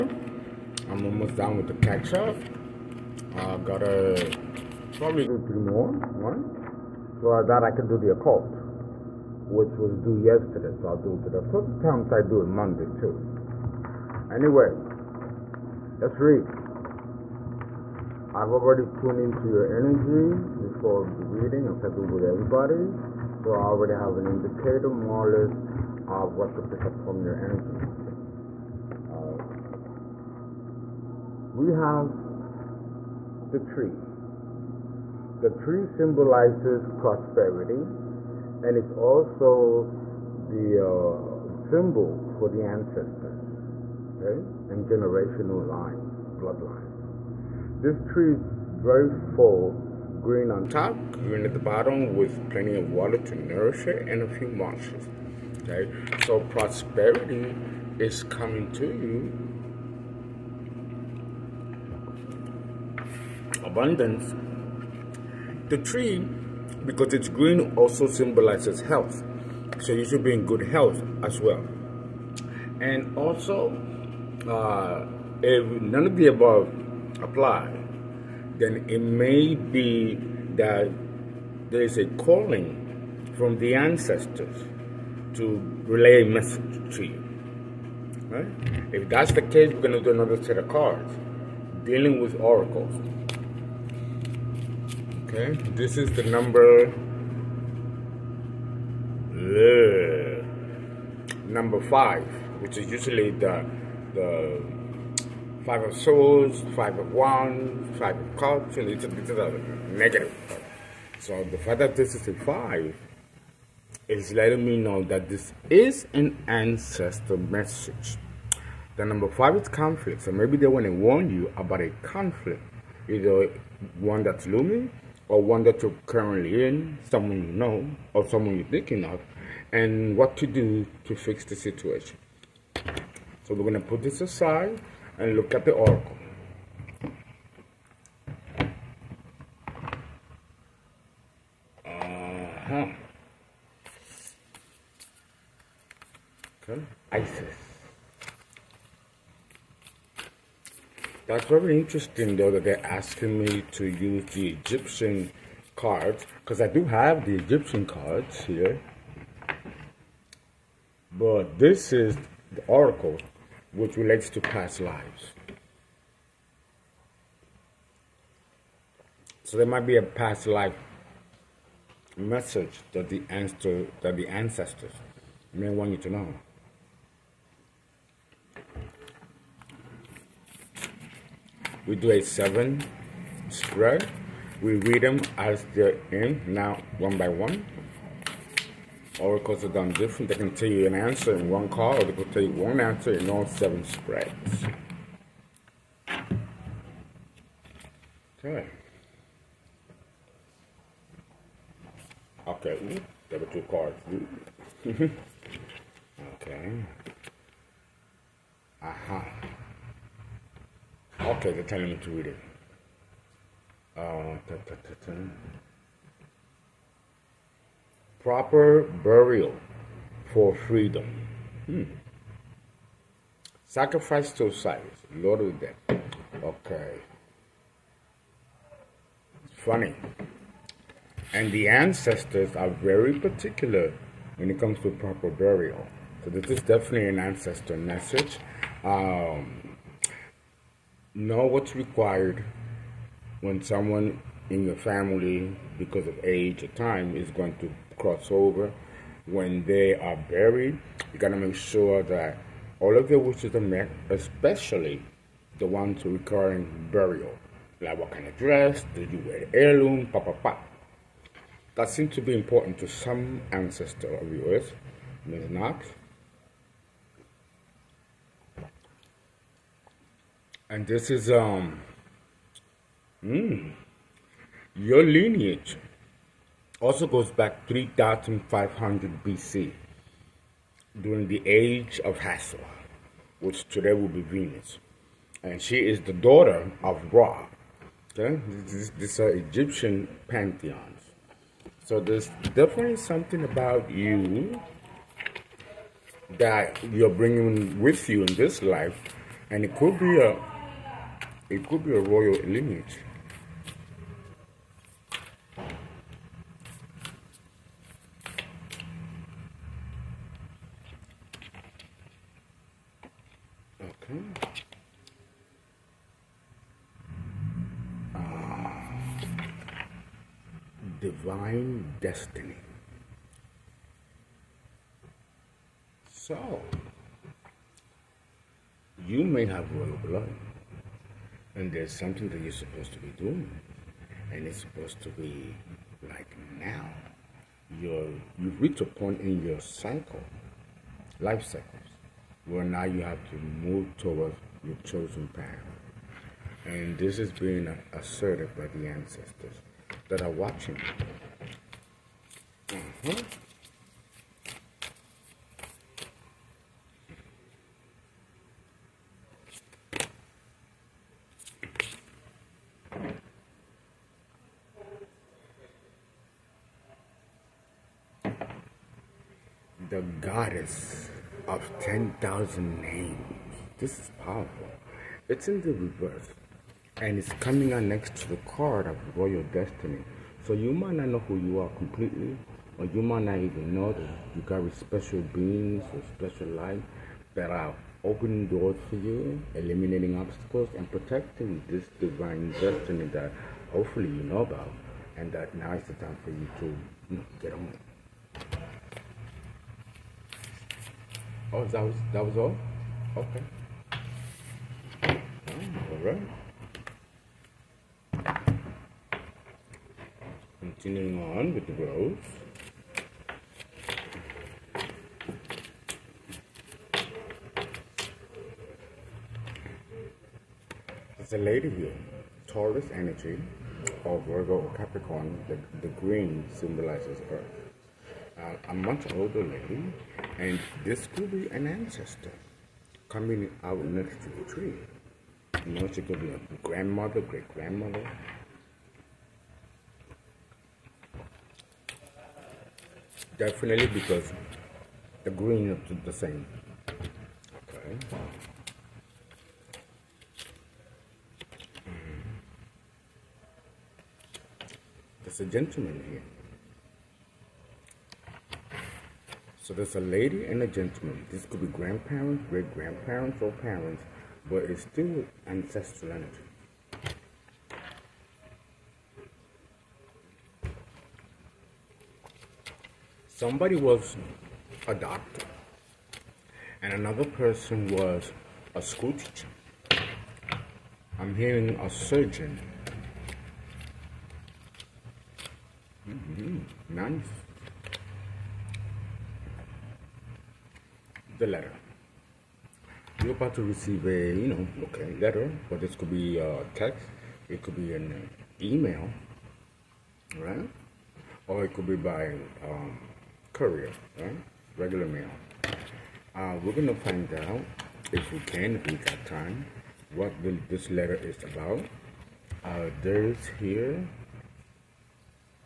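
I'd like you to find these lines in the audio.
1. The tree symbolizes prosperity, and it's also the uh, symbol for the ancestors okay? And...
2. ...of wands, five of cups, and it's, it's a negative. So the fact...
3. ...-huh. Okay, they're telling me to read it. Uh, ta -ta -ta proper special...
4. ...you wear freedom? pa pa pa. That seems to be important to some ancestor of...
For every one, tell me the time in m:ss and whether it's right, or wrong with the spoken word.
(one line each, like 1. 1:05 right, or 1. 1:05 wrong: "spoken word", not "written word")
1. 0:35 right
2. 1:46 right
3. 3:31 wrong: "burial", not "special"
4. 4:19 wrong: "heirloom", not "freedom".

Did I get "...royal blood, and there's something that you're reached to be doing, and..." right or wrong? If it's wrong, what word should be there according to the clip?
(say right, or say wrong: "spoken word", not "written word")
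wrong: "supposed", not "reached".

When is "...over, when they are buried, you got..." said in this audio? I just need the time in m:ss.
4:08.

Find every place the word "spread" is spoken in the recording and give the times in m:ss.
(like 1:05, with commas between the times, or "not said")
3:03, 3:13.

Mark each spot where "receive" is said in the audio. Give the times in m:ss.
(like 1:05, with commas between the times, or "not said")
8:13.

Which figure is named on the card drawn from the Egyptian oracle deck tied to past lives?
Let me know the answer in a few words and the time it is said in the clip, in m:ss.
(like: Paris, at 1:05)
Isis, at 2:27.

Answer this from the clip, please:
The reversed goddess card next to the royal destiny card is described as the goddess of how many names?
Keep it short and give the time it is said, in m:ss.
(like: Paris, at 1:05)
10,000, at 6:11.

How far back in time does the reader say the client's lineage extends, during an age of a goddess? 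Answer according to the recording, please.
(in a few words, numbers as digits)
3,500 BC.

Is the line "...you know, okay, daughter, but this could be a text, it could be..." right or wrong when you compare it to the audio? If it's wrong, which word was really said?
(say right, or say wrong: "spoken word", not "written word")
wrong: "letter", not "daughter".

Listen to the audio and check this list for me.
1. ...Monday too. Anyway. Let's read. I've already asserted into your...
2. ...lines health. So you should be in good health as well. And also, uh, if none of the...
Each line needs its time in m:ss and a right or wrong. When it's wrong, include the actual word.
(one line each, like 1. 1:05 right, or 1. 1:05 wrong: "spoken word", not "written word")
1. 0:12 wrong: "tuned", not "asserted"
2. 1:08 wrong: "symbolizes", not "lines".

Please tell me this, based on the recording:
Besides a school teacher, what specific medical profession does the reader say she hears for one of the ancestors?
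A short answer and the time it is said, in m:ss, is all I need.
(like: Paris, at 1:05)
Surgeon, at 8:01.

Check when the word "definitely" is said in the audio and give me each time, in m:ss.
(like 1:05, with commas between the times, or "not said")
3:56, 4:52, 7:23.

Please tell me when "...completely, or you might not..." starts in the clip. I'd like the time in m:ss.
6:21.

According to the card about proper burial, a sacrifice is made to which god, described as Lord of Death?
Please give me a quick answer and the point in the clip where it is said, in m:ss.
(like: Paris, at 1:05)
Osiris, at 3:44.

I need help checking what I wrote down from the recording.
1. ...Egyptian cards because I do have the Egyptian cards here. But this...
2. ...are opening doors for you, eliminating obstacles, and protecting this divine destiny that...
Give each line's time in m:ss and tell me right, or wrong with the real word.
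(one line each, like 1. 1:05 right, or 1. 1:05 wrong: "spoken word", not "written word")
1. 2:34 right
2. 6:27 right.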